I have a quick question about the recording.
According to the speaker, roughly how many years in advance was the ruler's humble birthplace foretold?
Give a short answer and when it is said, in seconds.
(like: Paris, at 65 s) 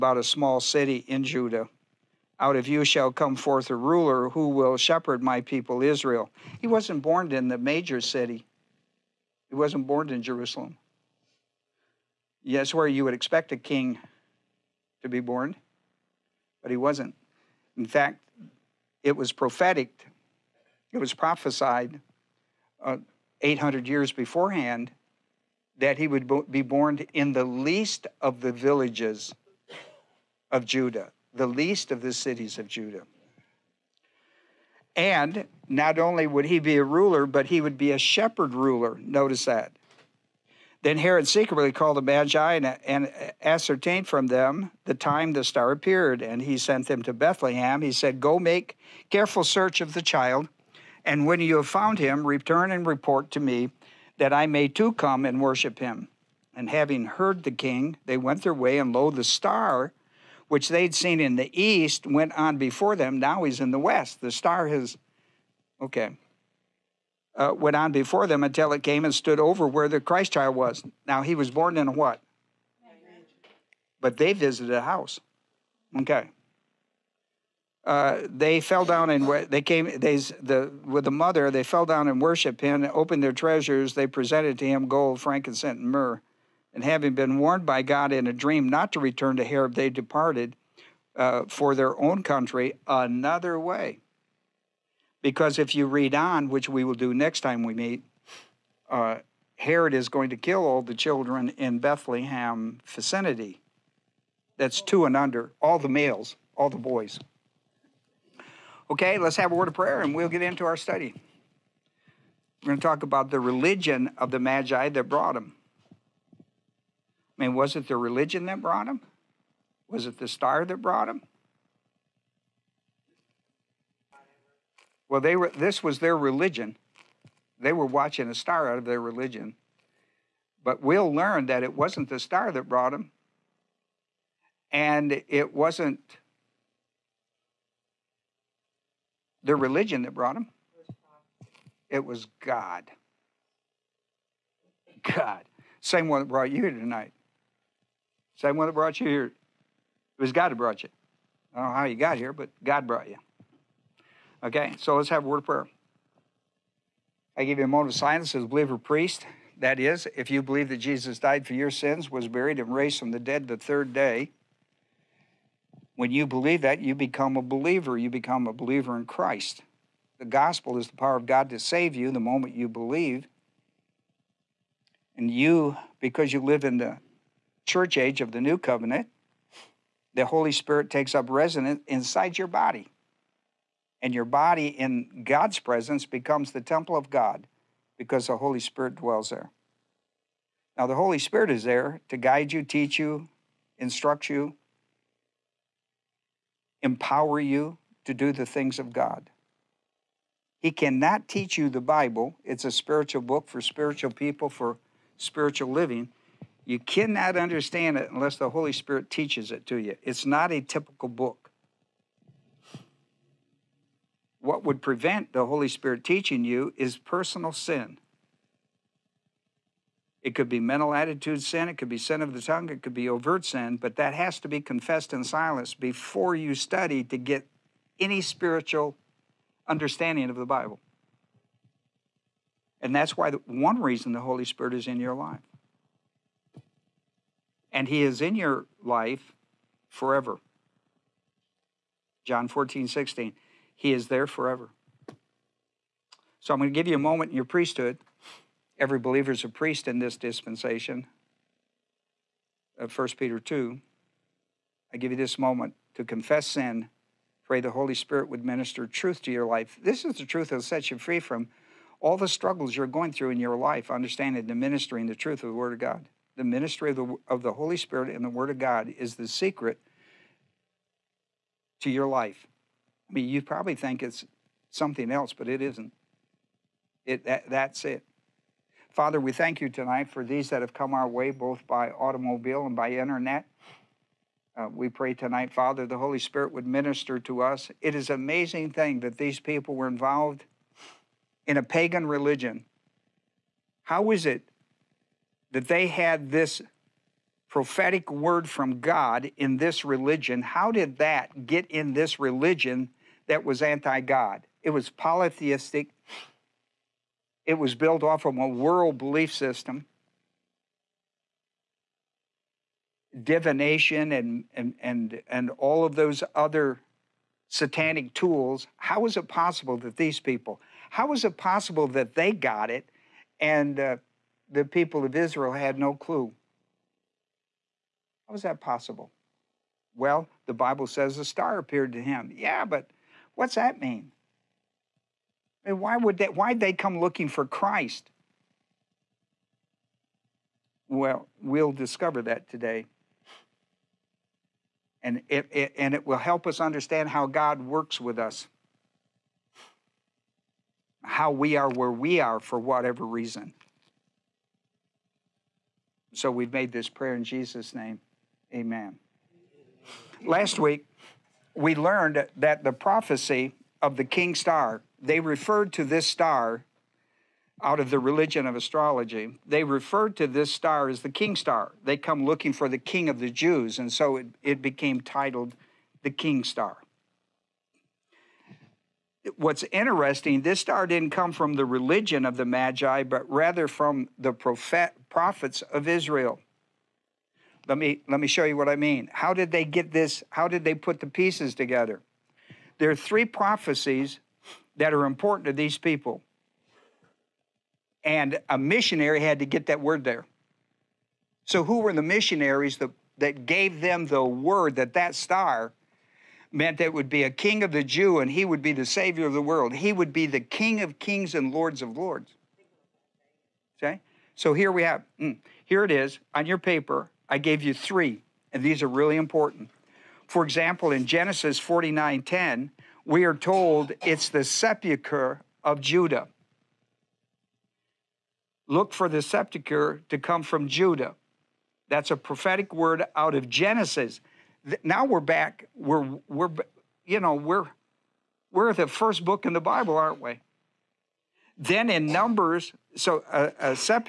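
800, at 23 s.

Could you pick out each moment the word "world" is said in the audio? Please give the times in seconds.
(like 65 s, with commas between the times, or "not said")
308 s, 409 s.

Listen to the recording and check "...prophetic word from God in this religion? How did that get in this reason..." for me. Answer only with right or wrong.
wrong.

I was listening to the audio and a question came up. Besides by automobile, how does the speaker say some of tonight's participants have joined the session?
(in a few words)
By internet.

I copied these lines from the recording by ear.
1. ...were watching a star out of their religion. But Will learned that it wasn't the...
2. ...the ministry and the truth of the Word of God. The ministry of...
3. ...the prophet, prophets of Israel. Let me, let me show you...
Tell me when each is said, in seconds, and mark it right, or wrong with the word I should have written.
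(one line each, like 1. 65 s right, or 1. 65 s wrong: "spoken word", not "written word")
1. 127 s right
2. 264 s right
3. 384 s right.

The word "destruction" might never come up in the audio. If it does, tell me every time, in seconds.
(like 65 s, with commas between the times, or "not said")
not said.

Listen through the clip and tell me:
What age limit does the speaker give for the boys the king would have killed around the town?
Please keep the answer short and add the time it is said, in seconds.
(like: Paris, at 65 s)
two and under, at 104 s.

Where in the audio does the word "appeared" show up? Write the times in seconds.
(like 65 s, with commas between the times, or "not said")
45 s, 331 s.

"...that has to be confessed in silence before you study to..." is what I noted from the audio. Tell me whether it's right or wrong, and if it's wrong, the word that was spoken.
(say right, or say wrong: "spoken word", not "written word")
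right.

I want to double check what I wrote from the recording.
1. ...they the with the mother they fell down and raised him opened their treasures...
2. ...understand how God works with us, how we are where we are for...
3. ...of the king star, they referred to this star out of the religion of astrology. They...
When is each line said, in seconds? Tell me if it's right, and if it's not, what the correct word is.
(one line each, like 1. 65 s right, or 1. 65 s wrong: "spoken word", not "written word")
1. 79 s wrong: "worshiped", not "raised"
2. 346 s right
3. 363 s right.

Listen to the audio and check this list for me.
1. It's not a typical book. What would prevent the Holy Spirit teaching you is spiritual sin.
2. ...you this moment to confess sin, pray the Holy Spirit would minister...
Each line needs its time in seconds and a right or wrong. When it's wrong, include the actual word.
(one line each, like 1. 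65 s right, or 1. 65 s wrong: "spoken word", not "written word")
1. 210 s wrong: "personal", not "spiritual"
2. 255 s right.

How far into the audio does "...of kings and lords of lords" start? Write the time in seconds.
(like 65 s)
410 s.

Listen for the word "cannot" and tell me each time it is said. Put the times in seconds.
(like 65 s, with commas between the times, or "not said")
200 s, 206 s.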